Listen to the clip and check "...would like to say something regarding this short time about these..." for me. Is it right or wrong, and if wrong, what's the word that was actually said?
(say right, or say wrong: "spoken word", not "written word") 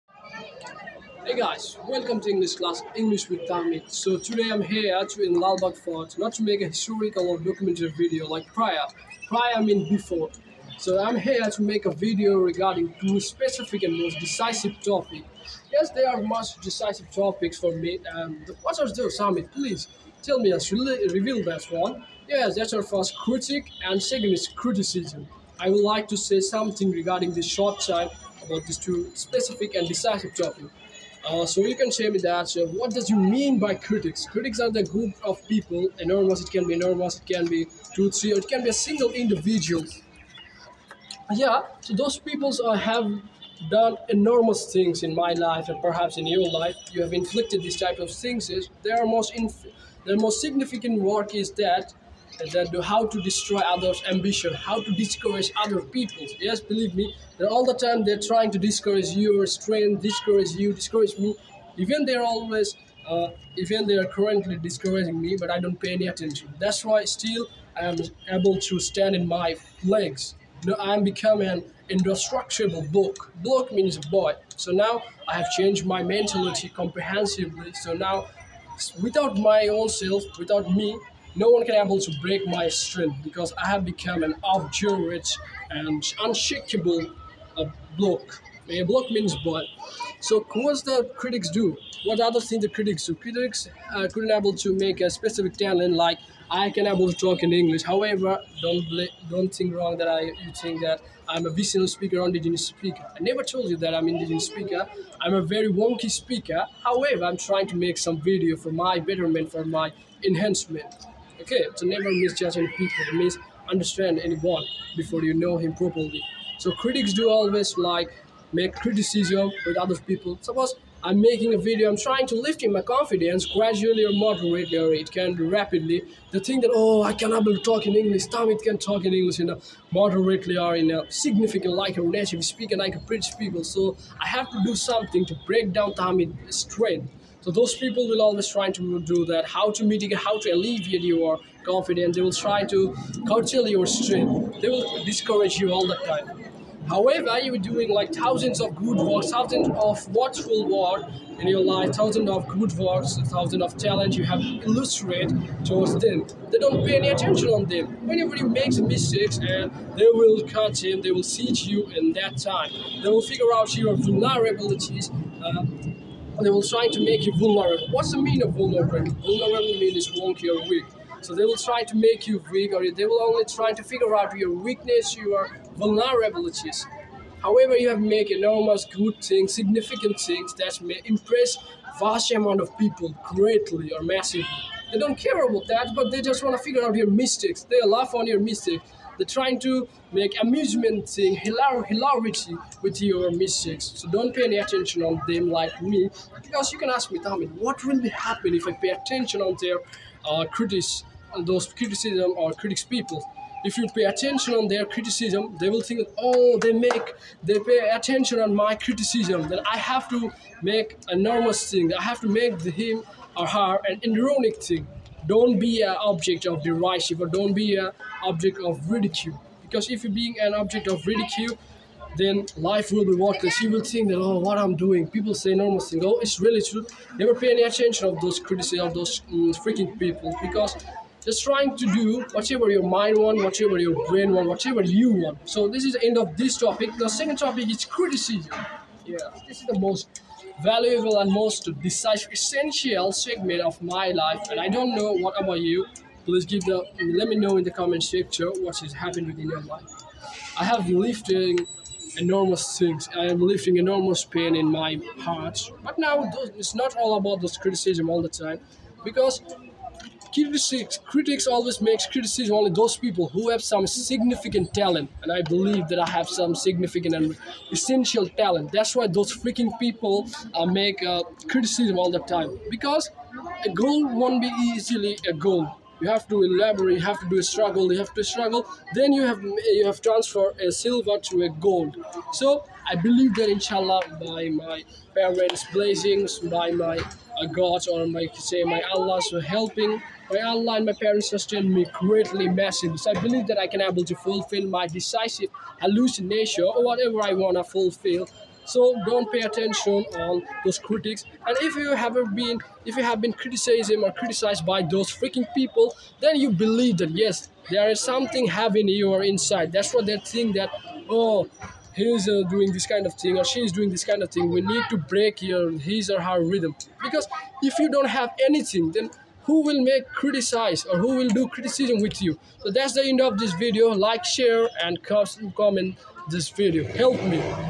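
right.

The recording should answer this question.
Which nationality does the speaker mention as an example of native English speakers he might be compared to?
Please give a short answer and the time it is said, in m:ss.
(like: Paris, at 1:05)
British, at 2:12.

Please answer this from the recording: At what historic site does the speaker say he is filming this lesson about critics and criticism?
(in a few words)
Lalbagh Fort.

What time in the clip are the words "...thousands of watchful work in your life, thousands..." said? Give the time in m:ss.
2:29.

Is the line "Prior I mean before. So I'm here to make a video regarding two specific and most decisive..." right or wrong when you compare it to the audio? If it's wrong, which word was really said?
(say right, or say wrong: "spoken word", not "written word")
right.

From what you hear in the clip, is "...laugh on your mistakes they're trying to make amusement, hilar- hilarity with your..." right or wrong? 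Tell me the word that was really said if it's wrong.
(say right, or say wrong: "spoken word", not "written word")
right.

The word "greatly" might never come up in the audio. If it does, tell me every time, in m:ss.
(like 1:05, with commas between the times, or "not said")
3:03, 4:51.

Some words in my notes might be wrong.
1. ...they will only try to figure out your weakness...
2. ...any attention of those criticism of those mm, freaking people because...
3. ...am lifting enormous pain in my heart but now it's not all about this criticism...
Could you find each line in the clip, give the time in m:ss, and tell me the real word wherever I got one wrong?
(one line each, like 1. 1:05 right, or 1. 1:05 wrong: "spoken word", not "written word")
1. 2:52 right
2. 3:47 right
3. 4:13 right.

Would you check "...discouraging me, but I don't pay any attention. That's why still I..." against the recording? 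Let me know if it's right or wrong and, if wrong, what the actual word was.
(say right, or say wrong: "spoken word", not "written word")
right.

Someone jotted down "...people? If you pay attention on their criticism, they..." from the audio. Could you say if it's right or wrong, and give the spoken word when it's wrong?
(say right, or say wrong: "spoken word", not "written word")
right.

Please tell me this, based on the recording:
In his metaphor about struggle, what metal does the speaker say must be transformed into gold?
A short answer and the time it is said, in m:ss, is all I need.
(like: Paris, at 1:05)
silver, at 4:40.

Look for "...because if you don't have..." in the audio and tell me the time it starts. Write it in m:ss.
5:17.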